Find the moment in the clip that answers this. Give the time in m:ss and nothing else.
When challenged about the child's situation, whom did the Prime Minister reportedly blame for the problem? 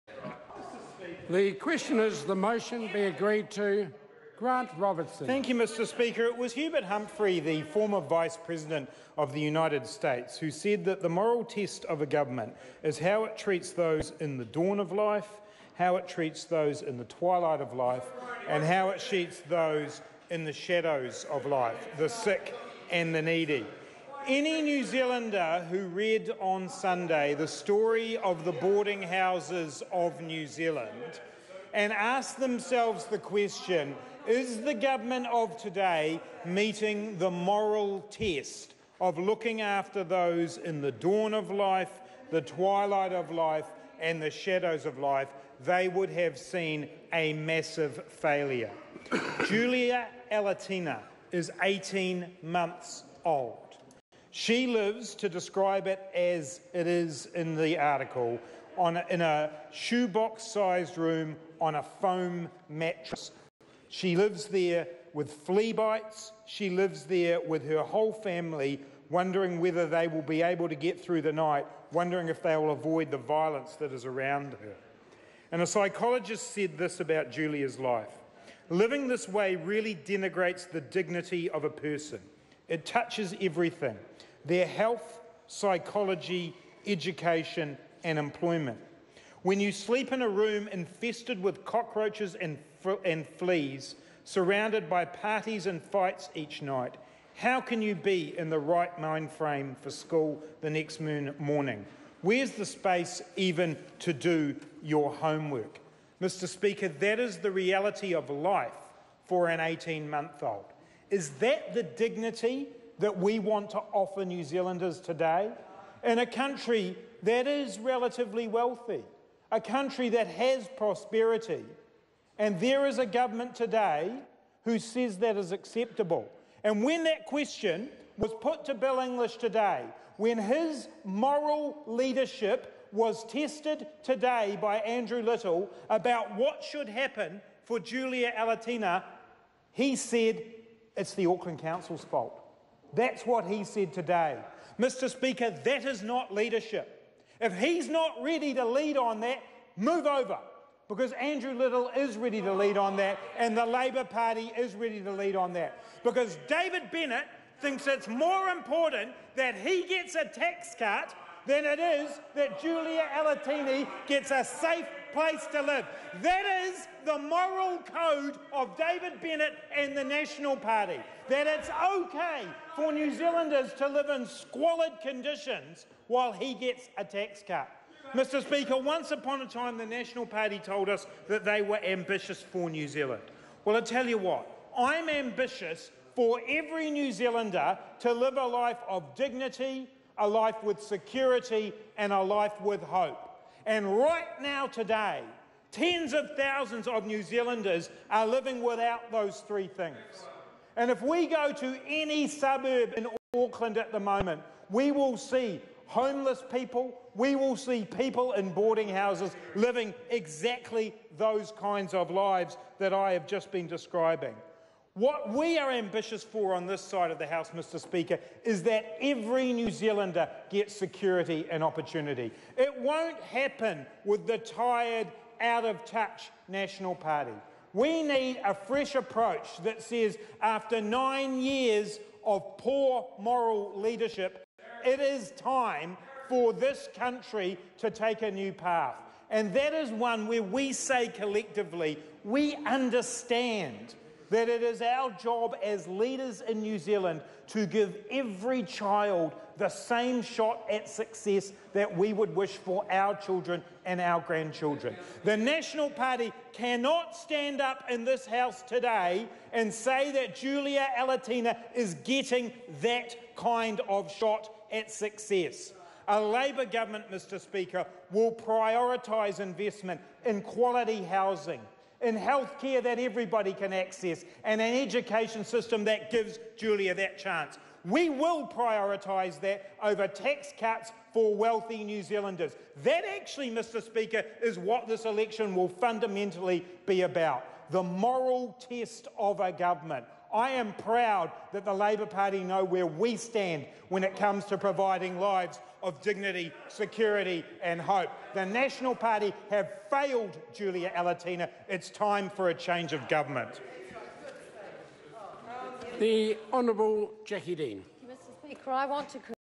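2:21.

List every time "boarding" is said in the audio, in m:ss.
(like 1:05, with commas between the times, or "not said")
0:28, 3:28.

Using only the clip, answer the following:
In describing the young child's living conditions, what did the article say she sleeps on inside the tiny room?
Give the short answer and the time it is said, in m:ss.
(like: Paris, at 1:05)
a foam mattress, at 1:01.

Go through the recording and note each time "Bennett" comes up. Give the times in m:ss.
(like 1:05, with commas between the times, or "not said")
2:36, 2:49.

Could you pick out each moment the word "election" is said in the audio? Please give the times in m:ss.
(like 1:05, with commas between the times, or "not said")
4:45.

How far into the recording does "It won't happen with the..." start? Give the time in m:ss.
3:42.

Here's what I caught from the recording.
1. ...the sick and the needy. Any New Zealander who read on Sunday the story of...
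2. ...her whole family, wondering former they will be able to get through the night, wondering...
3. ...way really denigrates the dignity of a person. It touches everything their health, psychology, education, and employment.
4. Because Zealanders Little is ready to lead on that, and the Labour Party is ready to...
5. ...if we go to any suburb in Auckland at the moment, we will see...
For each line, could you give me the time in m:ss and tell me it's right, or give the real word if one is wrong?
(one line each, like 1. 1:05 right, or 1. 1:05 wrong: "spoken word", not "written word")
1. 0:21 right
2. 1:07 wrong: "whether", not "former"
3. 1:19 right
4. 2:30 wrong: "Andrew", not "Zealanders"
5. 3:20 right.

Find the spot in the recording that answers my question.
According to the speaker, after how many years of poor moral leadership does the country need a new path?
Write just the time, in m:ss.
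3:50.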